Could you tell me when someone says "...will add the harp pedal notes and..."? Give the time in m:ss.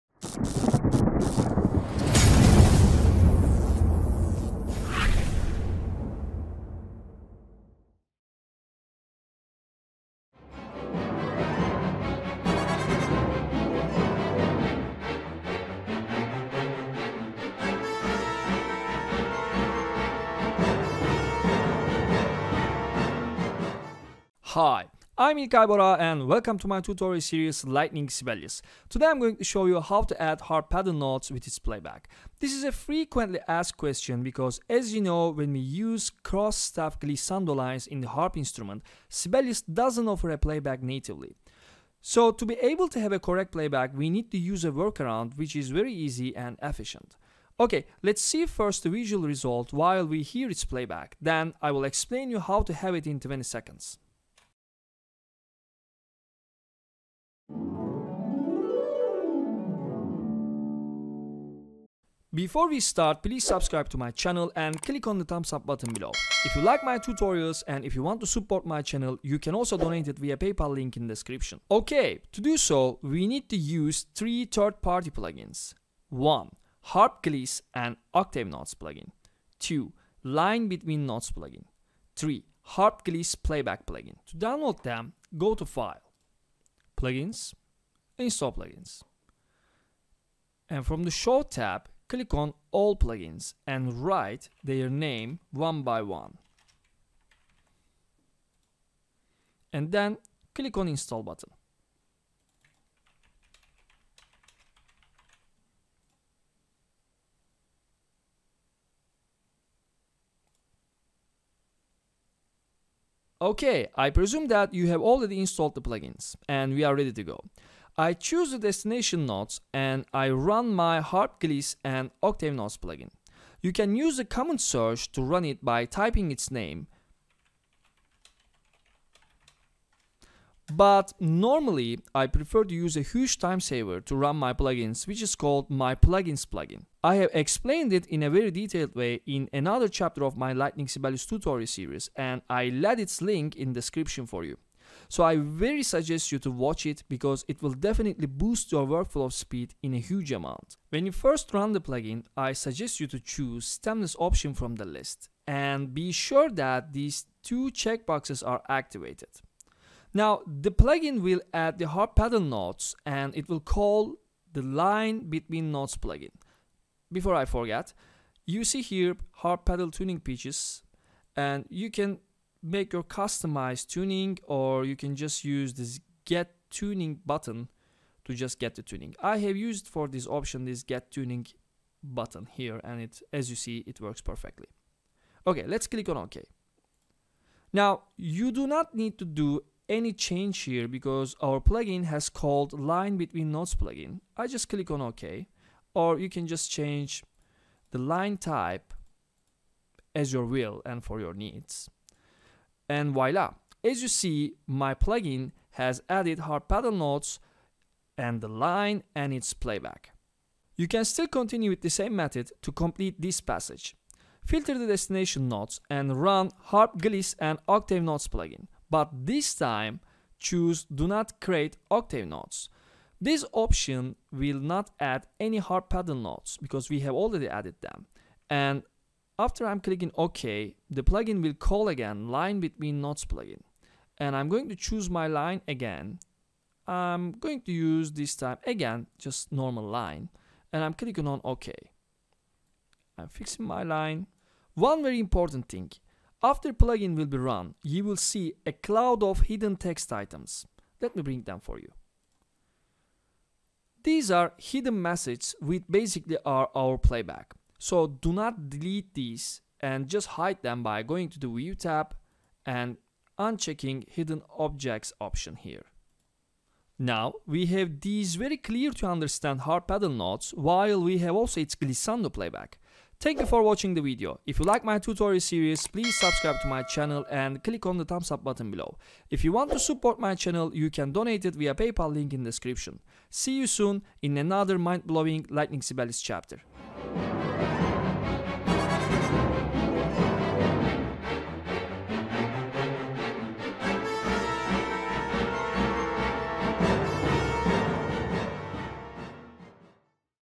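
2:41.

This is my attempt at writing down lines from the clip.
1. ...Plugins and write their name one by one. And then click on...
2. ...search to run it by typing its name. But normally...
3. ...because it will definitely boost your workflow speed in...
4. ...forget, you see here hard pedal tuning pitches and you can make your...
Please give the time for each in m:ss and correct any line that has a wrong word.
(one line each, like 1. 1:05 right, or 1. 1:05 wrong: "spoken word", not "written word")
1. 1:32 right
2. 2:04 right
3. 2:27 right
4. 2:47 right.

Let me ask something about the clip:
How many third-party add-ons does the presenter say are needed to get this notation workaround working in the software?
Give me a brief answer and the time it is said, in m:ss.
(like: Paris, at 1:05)
3, at 1:14.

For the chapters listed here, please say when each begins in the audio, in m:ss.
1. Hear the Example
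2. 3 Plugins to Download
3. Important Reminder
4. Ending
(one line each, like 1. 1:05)
1. 0:47
2. 1:17
3. 4:04
4. 4:30.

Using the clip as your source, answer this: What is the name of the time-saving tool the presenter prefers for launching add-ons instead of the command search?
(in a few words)
My Plugins plugin.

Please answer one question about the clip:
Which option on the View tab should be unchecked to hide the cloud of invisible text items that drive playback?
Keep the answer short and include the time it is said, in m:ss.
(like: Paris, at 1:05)
Hidden Objects, at 4:24.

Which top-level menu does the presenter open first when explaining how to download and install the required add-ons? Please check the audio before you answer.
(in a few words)
File.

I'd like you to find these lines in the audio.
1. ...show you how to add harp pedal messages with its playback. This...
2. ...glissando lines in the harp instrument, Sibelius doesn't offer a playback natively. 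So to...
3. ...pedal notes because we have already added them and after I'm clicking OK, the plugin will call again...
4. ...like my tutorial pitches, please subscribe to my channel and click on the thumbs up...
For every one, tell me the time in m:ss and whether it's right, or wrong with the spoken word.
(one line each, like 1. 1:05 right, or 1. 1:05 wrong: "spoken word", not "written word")
1. 0:29 wrong: "notes", not "messages"
2. 0:36 right
3. 3:45 right
4. 4:34 wrong: "series", not "pitches".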